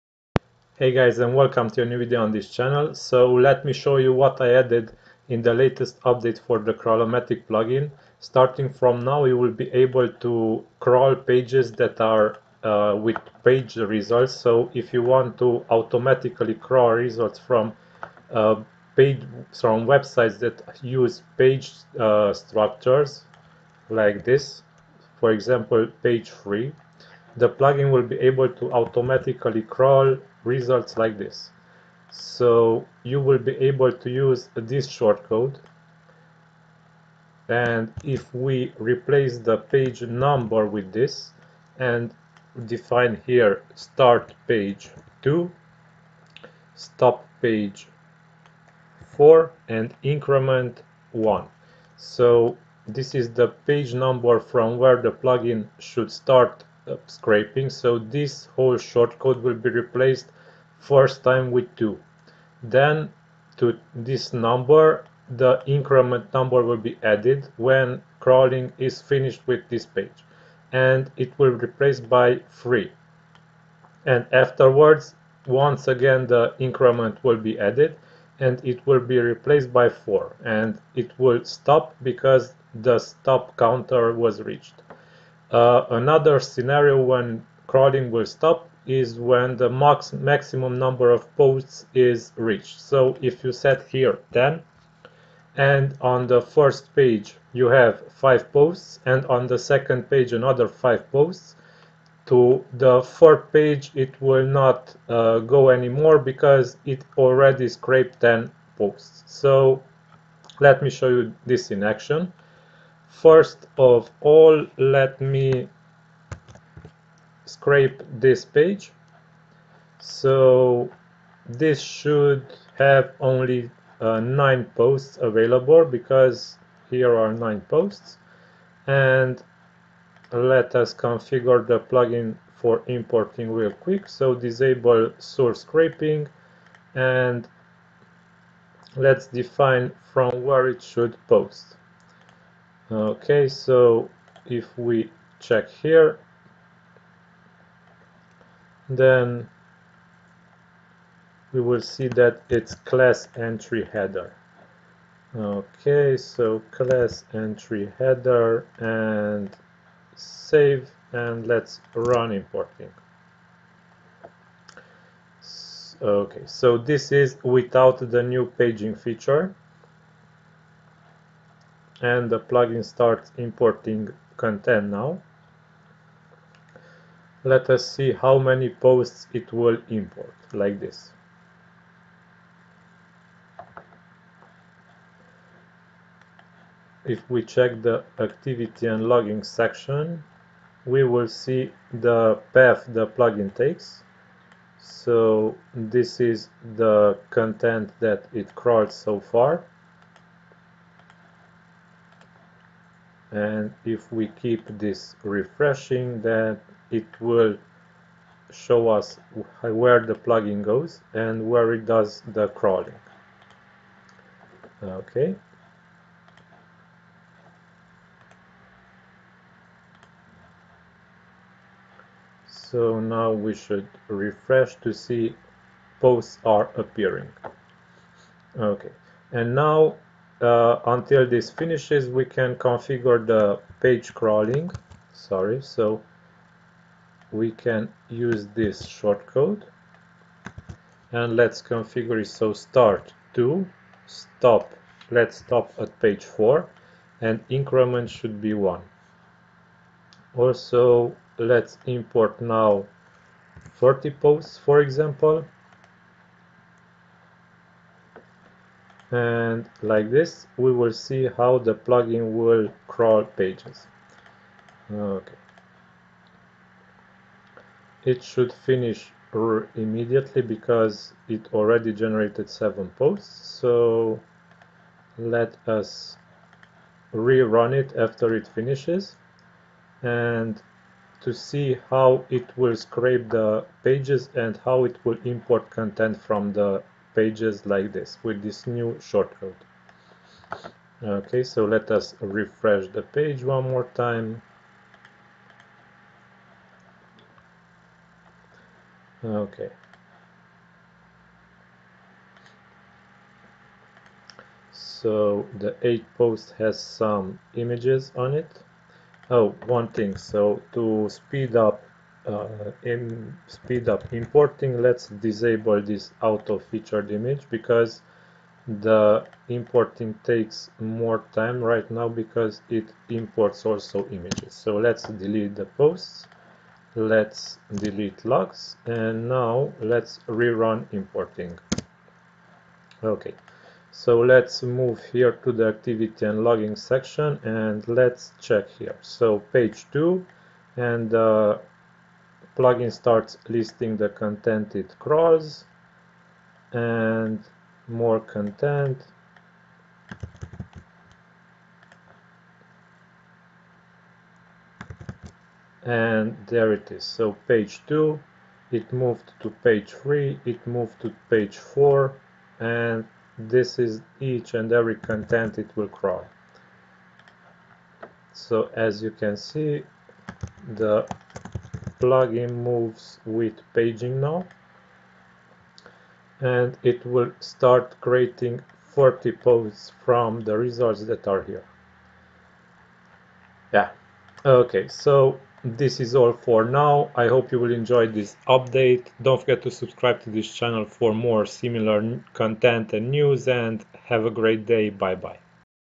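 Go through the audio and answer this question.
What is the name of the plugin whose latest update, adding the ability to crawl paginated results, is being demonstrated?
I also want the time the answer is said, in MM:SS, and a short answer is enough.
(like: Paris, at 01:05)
Crawlomatic, at 00:06.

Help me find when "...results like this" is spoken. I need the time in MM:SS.
00:30.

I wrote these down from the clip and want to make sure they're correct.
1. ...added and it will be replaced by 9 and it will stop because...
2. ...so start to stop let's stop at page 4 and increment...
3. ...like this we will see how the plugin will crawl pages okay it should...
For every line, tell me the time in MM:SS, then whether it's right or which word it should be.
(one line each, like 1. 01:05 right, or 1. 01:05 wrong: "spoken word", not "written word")
1. 01:17 wrong: "4", not "9"
2. 04:02 right
3. 04:19 right.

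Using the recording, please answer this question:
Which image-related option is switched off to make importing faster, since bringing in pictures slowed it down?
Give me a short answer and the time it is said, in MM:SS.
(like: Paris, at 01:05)
auto featured image, at 05:16.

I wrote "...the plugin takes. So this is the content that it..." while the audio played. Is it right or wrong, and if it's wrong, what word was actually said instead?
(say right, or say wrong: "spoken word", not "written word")
right.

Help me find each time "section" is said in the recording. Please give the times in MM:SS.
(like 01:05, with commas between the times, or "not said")
03:09, 05:36.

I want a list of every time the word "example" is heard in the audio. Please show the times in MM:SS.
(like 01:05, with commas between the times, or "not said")
00:25, 04:14.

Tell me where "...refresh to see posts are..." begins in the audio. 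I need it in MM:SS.
03:44.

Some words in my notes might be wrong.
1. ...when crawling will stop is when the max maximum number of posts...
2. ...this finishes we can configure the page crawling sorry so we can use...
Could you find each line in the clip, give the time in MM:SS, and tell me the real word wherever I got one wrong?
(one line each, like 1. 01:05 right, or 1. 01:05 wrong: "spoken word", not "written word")
1. 01:27 right
2. 03:51 right.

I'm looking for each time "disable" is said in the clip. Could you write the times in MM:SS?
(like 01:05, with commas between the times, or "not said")
02:14, 05:15.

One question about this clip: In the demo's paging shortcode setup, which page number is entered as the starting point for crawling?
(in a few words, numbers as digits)
2.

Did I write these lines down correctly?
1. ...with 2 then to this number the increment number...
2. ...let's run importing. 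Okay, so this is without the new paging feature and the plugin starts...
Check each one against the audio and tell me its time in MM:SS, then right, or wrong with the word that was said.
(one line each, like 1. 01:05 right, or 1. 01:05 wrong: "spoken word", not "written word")
1. 01:01 right
2. 02:41 right.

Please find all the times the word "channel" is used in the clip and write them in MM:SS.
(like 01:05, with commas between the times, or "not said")
00:02, 06:30.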